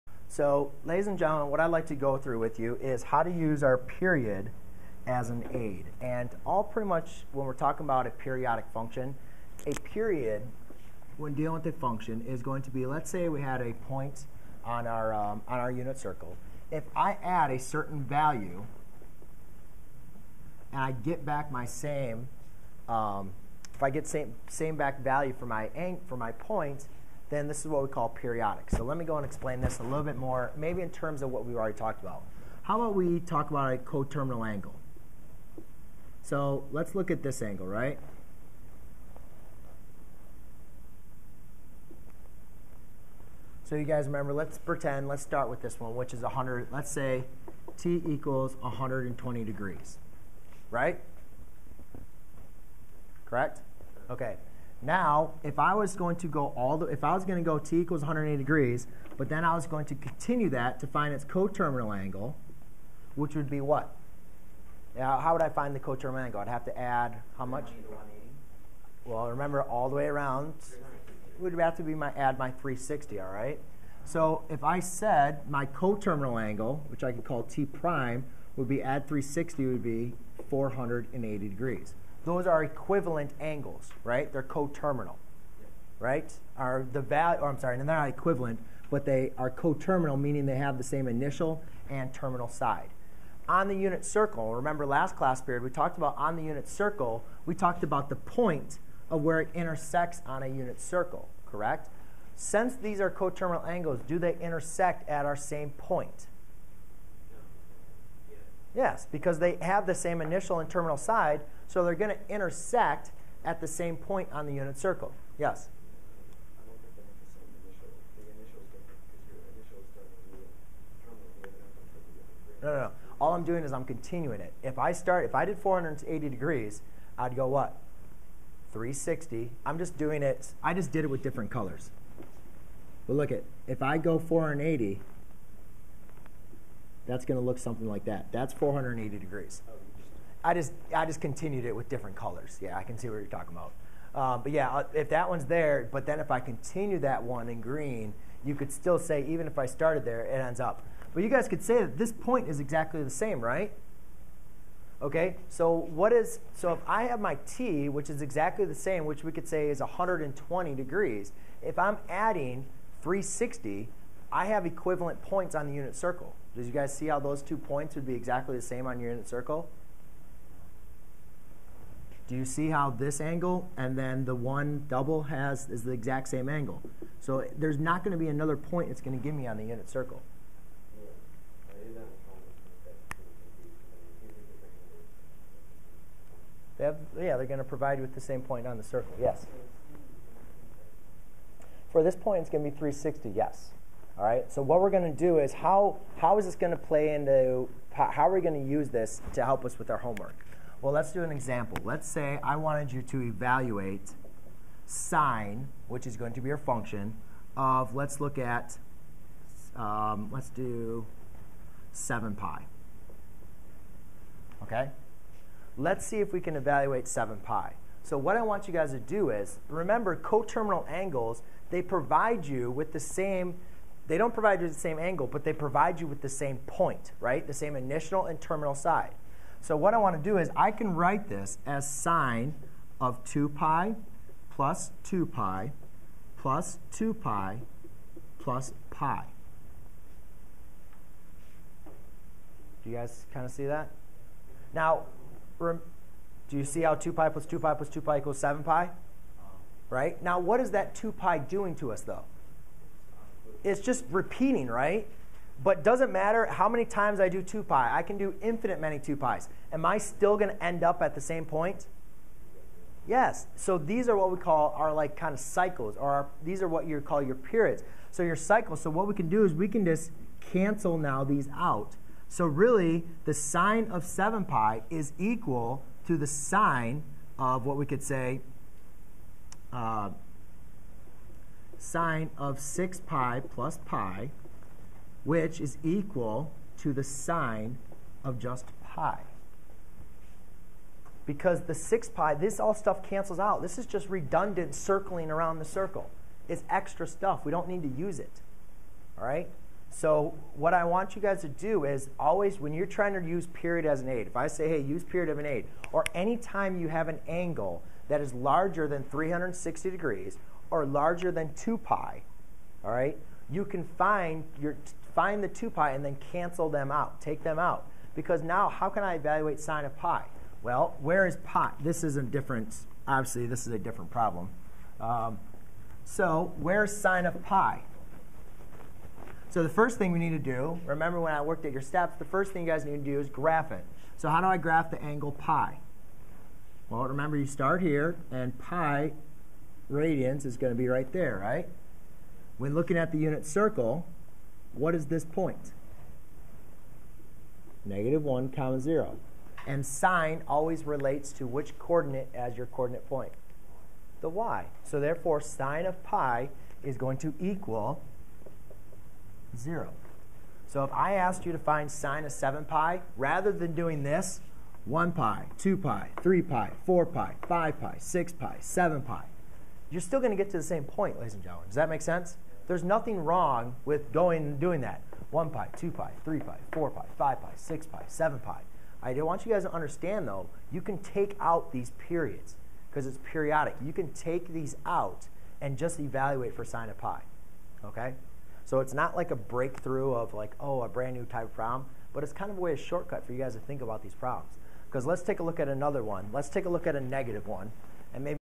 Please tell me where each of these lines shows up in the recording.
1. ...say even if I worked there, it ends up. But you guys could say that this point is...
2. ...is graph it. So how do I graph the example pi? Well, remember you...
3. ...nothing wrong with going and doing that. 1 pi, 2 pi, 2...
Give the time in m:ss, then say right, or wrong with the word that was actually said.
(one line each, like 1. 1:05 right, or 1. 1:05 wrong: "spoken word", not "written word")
1. 2:28 wrong: "started", not "worked"
2. 5:33 wrong: "angle", not "example"
3. 6:12 wrong: "3", not "2".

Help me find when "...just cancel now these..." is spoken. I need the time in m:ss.
4:29.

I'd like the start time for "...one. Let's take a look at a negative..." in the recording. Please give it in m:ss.
6:36.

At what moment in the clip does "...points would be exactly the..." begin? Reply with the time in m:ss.
2:47.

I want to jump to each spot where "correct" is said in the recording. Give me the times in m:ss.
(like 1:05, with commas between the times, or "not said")
0:53, 1:41.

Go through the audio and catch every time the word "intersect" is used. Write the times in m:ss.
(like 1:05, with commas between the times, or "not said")
1:39, 1:44, 1:52.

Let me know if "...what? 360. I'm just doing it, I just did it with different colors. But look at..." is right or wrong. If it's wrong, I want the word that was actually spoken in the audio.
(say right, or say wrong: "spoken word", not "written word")
right.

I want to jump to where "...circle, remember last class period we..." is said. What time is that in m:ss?
1:34.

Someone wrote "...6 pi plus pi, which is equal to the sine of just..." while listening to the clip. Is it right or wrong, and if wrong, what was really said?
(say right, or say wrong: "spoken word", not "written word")
right.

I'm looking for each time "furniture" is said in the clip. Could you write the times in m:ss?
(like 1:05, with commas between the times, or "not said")
not said.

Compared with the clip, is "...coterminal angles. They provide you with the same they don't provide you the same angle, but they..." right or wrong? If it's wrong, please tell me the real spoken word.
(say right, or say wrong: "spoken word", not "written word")
right.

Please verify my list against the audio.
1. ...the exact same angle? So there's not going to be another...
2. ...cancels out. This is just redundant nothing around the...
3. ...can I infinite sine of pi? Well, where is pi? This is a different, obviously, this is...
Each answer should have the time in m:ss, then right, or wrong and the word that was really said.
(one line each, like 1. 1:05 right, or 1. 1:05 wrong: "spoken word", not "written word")
1. 2:55 right
2. 4:53 wrong: "circling", not "nothing"
3. 5:18 wrong: "evaluate", not "infinite".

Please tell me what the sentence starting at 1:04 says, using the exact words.
Now, how would I find the coterminal angle?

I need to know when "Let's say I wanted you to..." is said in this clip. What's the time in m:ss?
3:21.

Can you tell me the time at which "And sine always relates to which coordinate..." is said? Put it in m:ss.
5:49.